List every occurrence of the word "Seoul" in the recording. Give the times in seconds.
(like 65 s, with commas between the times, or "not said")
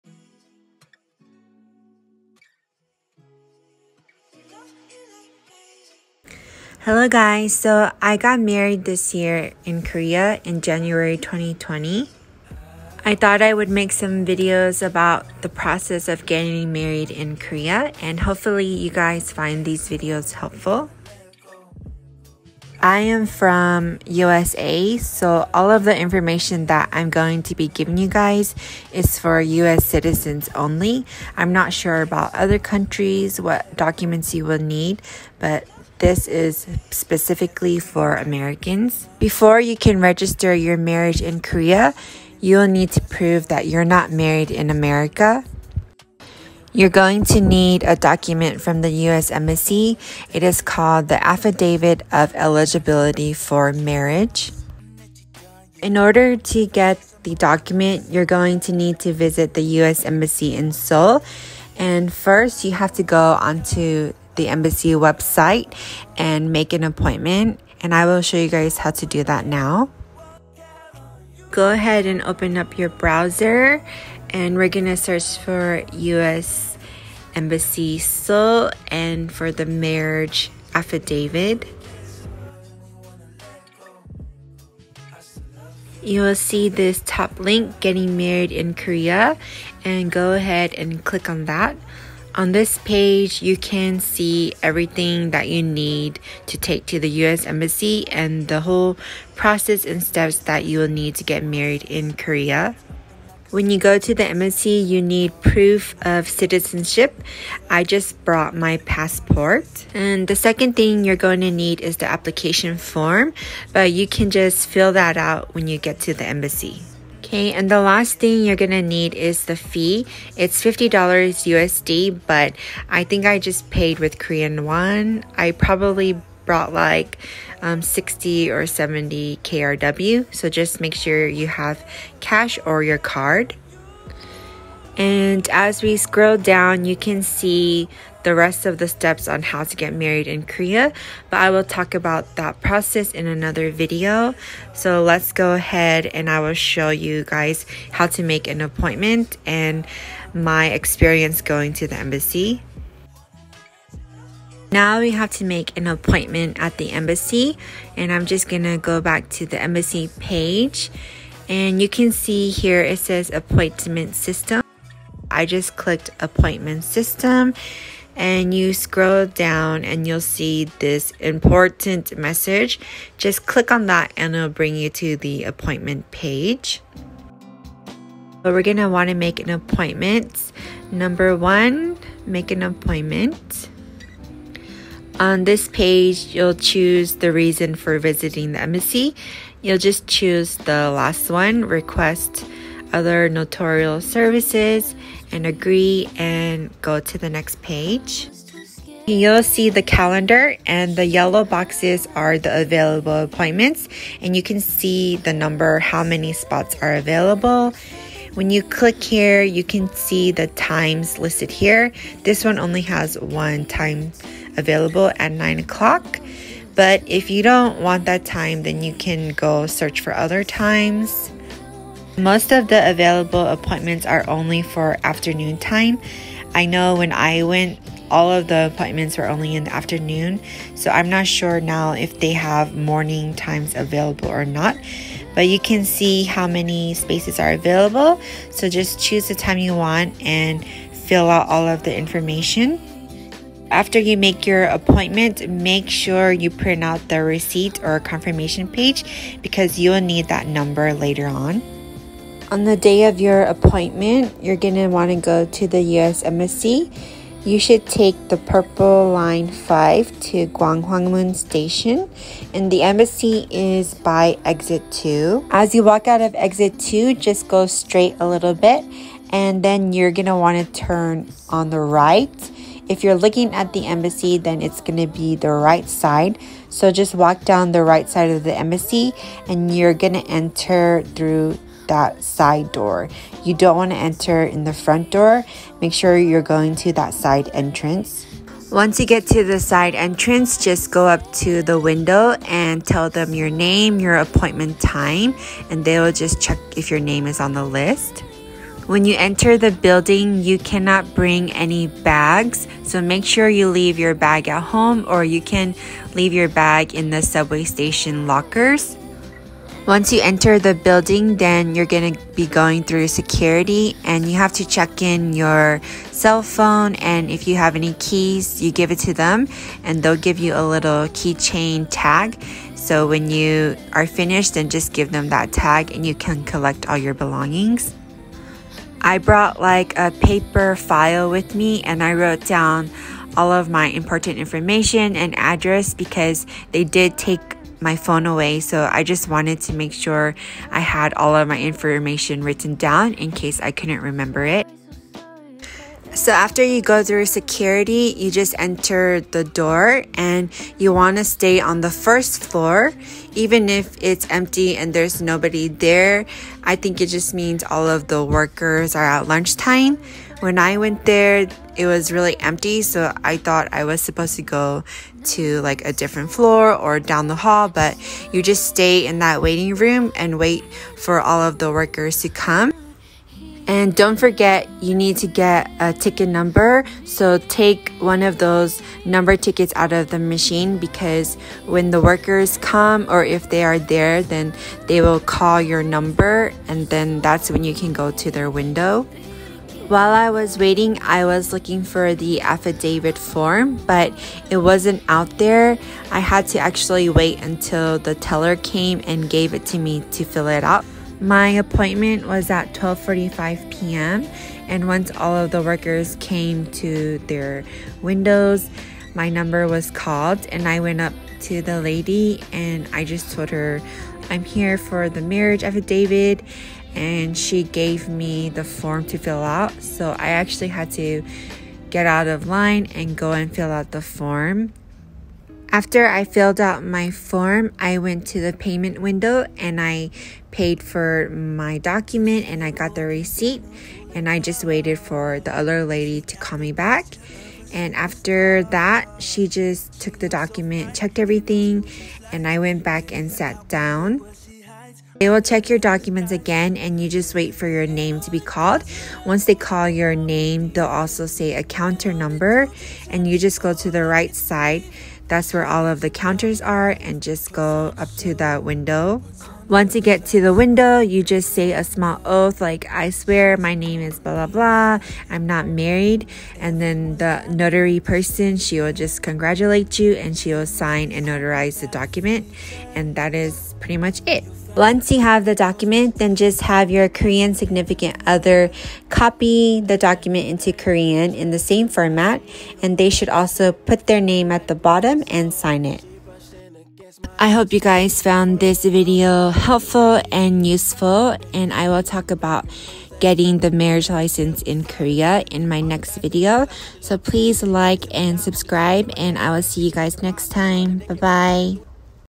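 60 s, 77 s.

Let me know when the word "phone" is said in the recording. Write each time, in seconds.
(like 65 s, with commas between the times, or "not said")
316 s, 337 s.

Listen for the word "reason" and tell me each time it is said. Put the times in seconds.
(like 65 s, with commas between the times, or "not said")
187 s.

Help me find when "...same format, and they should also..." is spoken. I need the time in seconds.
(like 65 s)
481 s.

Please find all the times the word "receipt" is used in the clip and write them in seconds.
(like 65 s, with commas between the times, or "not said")
247 s, 433 s.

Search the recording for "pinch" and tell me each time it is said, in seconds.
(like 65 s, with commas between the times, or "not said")
not said.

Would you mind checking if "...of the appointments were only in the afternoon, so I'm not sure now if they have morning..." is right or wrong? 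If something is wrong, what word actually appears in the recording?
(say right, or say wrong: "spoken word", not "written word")
right.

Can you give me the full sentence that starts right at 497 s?
So please like and subscribe, and I will see you guys next time.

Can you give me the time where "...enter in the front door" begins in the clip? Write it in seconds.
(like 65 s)
283 s.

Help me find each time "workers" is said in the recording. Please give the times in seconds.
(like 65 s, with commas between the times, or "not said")
358 s, 371 s, 382 s, 405 s.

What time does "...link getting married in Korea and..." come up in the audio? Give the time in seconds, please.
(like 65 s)
87 s.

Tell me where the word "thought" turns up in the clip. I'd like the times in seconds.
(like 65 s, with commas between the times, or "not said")
13 s, 363 s.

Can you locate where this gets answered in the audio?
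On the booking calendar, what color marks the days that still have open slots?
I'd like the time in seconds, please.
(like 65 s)
201 s.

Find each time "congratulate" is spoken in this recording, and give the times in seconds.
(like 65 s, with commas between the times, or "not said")
469 s.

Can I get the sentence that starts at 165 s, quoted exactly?
I just clicked appointment system and you scroll down and you'll see this important message.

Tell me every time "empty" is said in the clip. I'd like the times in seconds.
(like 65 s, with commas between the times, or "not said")
354 s, 362 s.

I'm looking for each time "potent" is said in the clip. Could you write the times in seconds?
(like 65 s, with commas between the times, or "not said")
not said.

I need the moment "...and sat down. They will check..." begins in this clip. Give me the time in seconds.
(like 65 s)
443 s.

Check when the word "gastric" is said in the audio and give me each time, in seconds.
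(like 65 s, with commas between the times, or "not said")
not said.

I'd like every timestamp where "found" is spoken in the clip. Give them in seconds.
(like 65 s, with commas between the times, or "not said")
488 s.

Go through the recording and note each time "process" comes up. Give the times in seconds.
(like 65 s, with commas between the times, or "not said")
15 s, 99 s, 142 s.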